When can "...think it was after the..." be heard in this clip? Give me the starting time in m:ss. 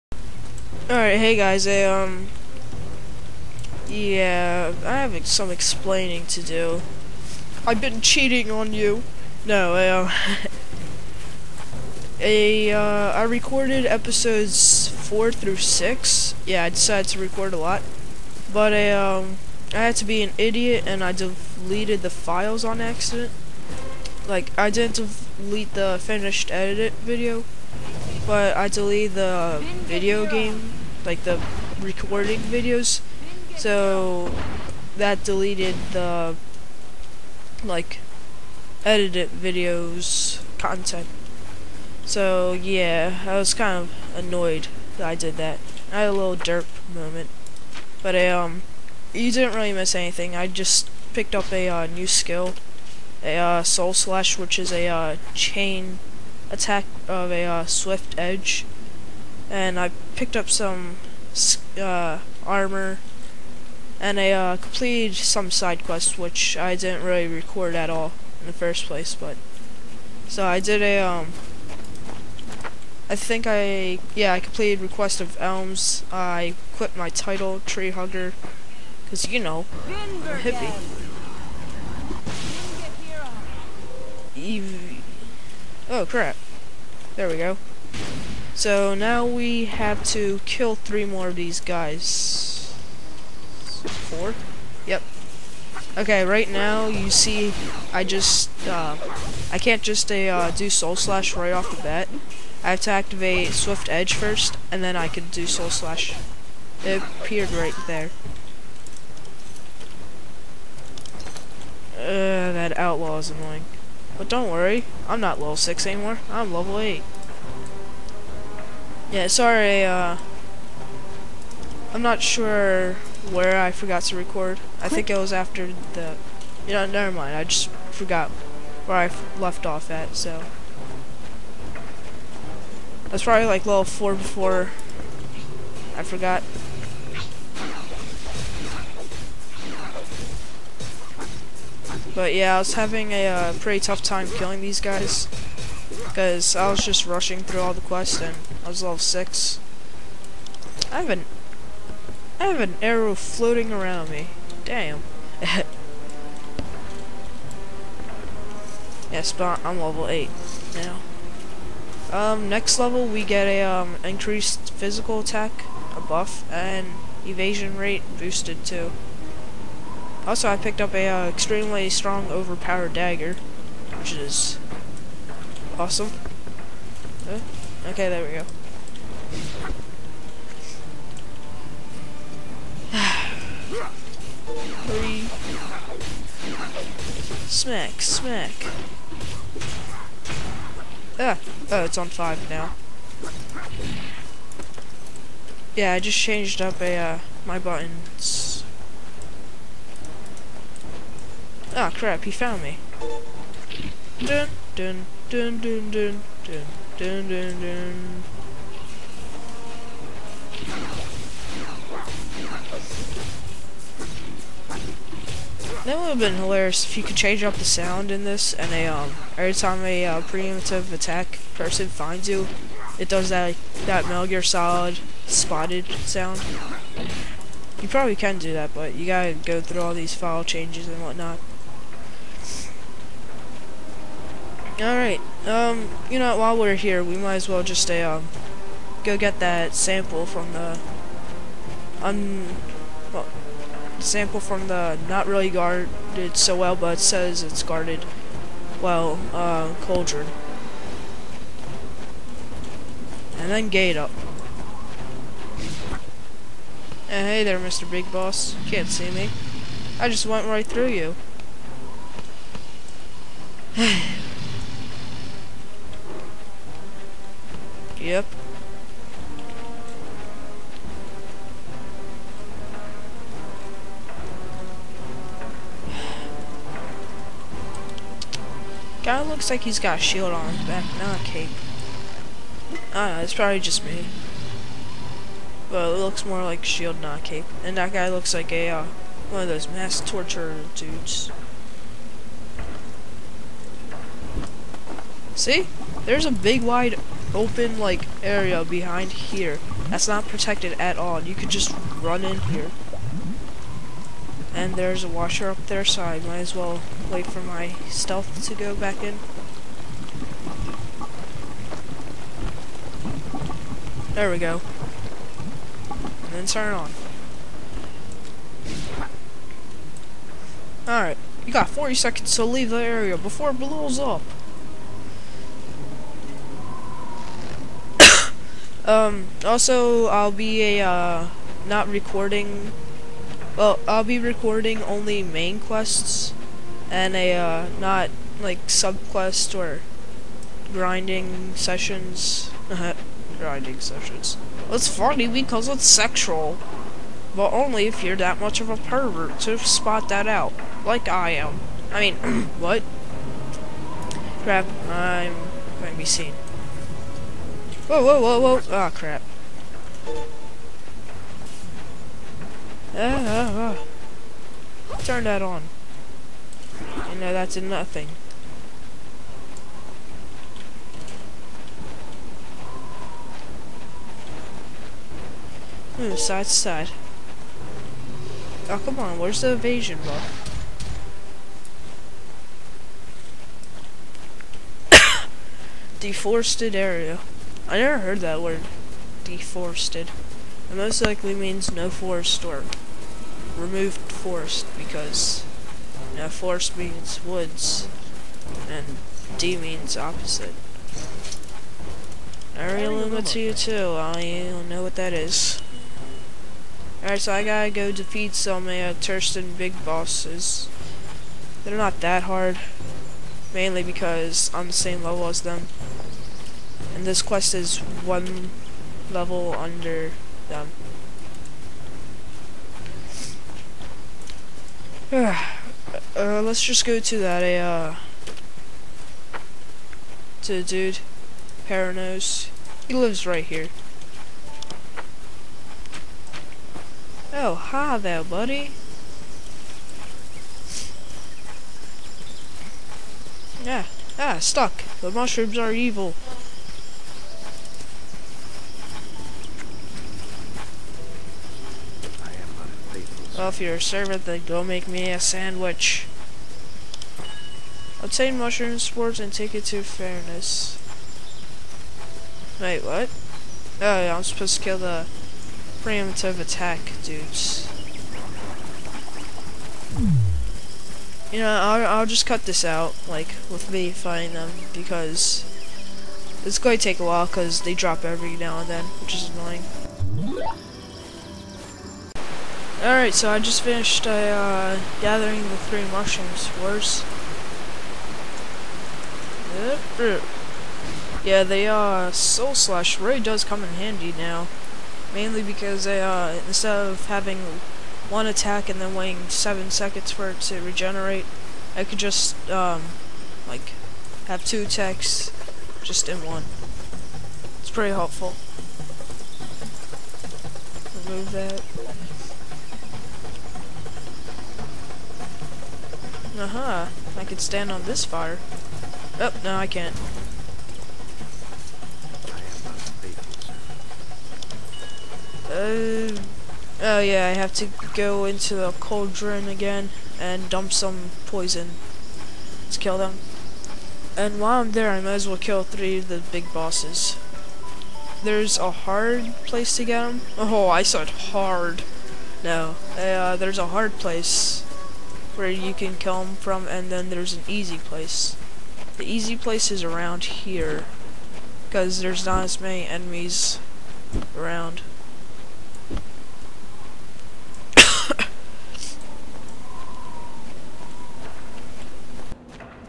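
2:04.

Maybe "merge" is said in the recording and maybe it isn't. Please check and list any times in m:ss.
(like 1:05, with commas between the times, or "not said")
not said.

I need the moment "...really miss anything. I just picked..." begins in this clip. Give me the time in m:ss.
0:49.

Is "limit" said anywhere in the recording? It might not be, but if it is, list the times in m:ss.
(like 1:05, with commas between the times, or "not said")
6:42.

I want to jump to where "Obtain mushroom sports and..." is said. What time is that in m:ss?
7:38.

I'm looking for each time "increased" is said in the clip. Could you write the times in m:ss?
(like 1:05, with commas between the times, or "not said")
2:44.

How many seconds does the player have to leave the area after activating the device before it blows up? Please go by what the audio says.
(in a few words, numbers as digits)
40.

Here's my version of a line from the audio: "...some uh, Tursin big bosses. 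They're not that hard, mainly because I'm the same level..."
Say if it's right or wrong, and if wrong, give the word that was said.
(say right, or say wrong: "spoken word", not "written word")
right.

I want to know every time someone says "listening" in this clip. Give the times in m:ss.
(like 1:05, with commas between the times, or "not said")
not said.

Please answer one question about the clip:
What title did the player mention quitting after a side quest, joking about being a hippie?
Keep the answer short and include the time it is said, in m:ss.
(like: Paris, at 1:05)
Tree Hugger, at 1:17.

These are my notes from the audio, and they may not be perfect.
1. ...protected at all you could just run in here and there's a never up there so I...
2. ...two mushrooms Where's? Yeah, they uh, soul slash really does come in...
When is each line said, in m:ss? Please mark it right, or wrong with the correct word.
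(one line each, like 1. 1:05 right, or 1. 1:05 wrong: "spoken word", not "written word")
1. 5:00 wrong: "washer", not "never"
2. 8:05 wrong: "three", not "two".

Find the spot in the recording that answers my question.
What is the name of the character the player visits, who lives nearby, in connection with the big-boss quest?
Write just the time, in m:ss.
7:11.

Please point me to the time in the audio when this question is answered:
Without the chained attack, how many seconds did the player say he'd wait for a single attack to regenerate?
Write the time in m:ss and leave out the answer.
8:19.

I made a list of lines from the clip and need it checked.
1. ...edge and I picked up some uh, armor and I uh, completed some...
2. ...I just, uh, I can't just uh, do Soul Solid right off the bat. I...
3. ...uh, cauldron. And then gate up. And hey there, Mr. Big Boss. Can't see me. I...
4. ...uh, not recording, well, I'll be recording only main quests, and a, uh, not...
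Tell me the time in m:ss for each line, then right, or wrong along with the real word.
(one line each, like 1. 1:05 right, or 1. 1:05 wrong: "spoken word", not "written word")
1. 0:58 right
2. 1:37 wrong: "Slash", not "Solid"
3. 4:09 right
4. 5:30 right.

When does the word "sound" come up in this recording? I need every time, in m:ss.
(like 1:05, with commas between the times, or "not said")
3:37, 3:46.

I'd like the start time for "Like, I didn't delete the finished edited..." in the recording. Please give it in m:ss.
0:24.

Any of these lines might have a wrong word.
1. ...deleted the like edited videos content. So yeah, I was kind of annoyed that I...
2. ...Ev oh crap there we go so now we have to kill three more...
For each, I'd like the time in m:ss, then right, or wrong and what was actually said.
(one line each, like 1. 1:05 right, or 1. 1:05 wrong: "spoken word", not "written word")
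1. 0:35 right
2. 1:24 right.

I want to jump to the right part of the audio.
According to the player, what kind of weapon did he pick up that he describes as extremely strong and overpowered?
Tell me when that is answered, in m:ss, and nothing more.
2:52.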